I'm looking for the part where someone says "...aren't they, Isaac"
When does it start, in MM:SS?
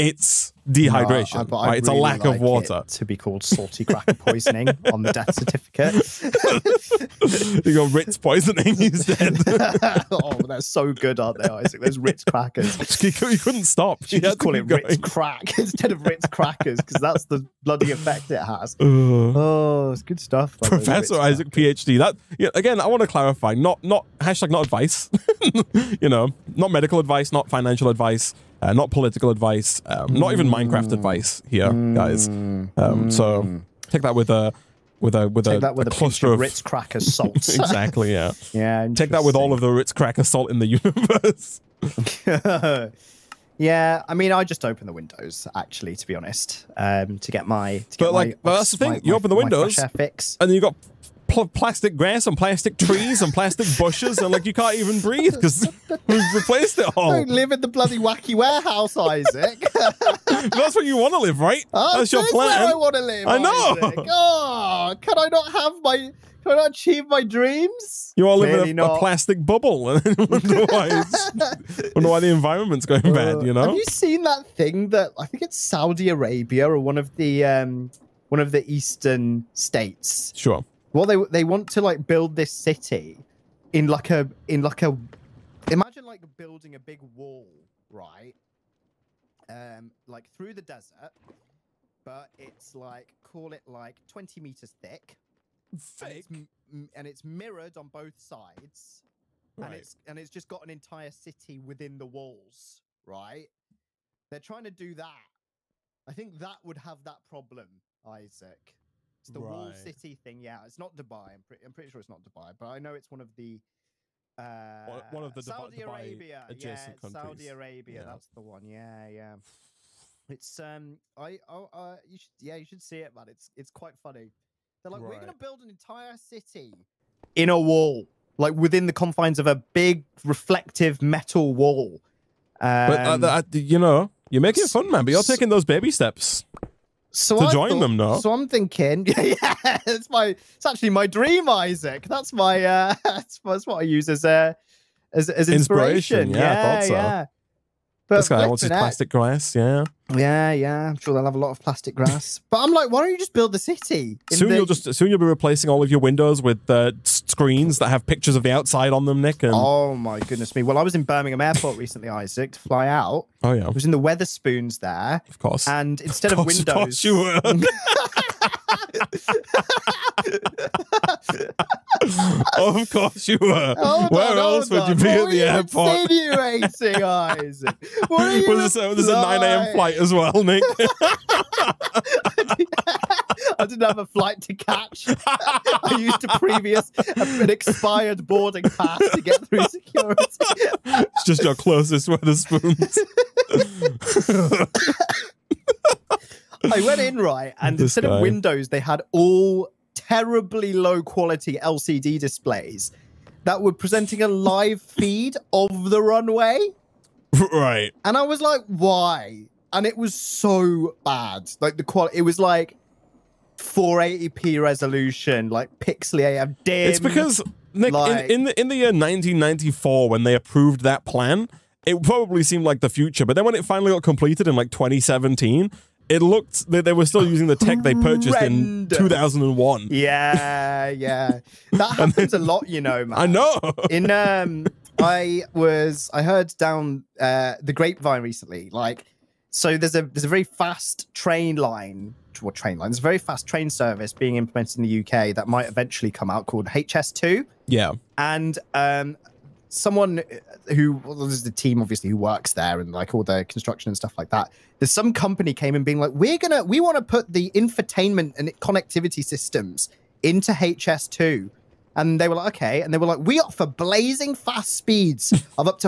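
00:11.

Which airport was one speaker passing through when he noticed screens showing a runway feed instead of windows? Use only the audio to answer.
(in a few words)
Birmingham Airport.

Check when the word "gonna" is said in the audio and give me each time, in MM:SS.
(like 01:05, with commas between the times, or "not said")
02:05, 04:16.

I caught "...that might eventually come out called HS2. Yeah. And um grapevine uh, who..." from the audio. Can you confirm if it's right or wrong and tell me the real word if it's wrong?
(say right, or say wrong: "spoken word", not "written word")
wrong: "someone", not "grapevine".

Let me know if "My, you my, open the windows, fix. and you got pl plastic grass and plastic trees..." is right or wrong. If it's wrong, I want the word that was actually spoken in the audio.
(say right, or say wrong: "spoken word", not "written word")
right.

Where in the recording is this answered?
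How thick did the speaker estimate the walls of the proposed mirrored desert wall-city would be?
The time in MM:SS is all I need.
01:34.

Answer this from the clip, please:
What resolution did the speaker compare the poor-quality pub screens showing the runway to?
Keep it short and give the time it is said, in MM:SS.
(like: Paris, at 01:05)
480p, at 03:33.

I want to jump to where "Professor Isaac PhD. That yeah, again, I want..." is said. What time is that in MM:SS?
00:20.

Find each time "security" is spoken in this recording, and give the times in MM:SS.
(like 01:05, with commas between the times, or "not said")
03:09.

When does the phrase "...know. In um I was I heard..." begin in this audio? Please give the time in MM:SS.
03:53.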